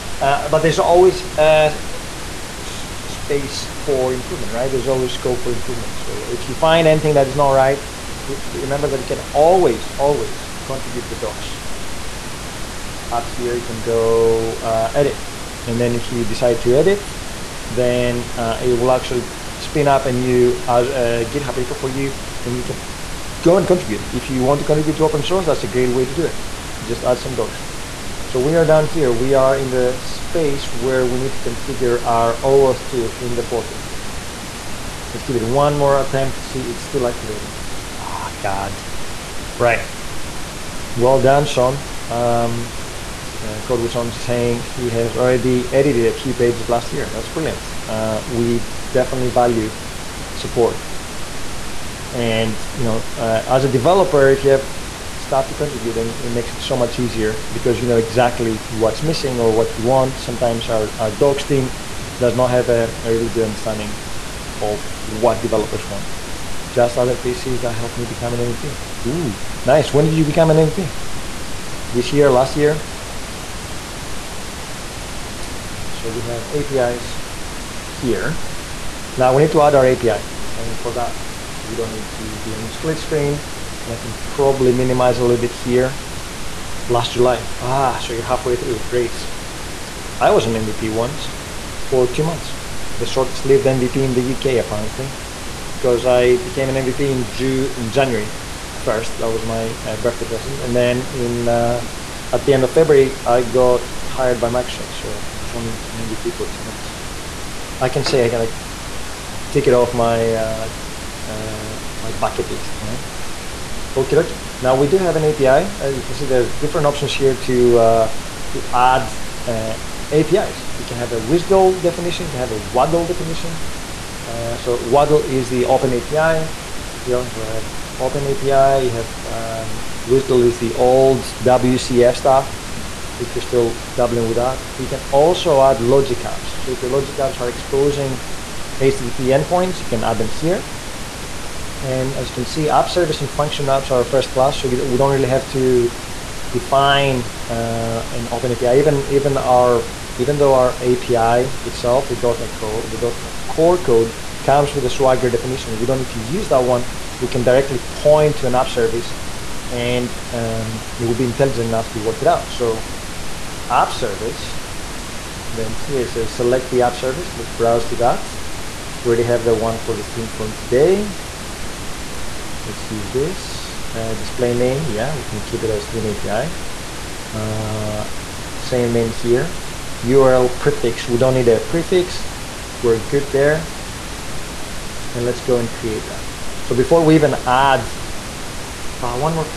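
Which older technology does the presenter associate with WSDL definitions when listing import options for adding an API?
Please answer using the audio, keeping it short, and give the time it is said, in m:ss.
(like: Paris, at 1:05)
WCF, at 2:11.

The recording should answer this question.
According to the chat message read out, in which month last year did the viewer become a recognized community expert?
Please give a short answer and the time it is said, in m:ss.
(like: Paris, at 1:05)
July, at 1:26.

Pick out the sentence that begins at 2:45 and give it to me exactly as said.
Then here it says select the app service.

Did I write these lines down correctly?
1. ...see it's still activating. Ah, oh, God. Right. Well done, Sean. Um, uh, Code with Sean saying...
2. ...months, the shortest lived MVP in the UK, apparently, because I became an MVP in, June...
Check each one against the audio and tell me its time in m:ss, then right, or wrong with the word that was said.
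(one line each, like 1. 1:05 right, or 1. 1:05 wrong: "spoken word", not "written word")
1. 0:36 right
2. 1:32 right.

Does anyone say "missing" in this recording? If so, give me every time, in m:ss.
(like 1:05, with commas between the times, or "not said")
0:59.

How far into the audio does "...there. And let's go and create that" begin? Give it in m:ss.
3:03.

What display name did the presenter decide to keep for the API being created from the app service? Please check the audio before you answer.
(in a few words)
stream API.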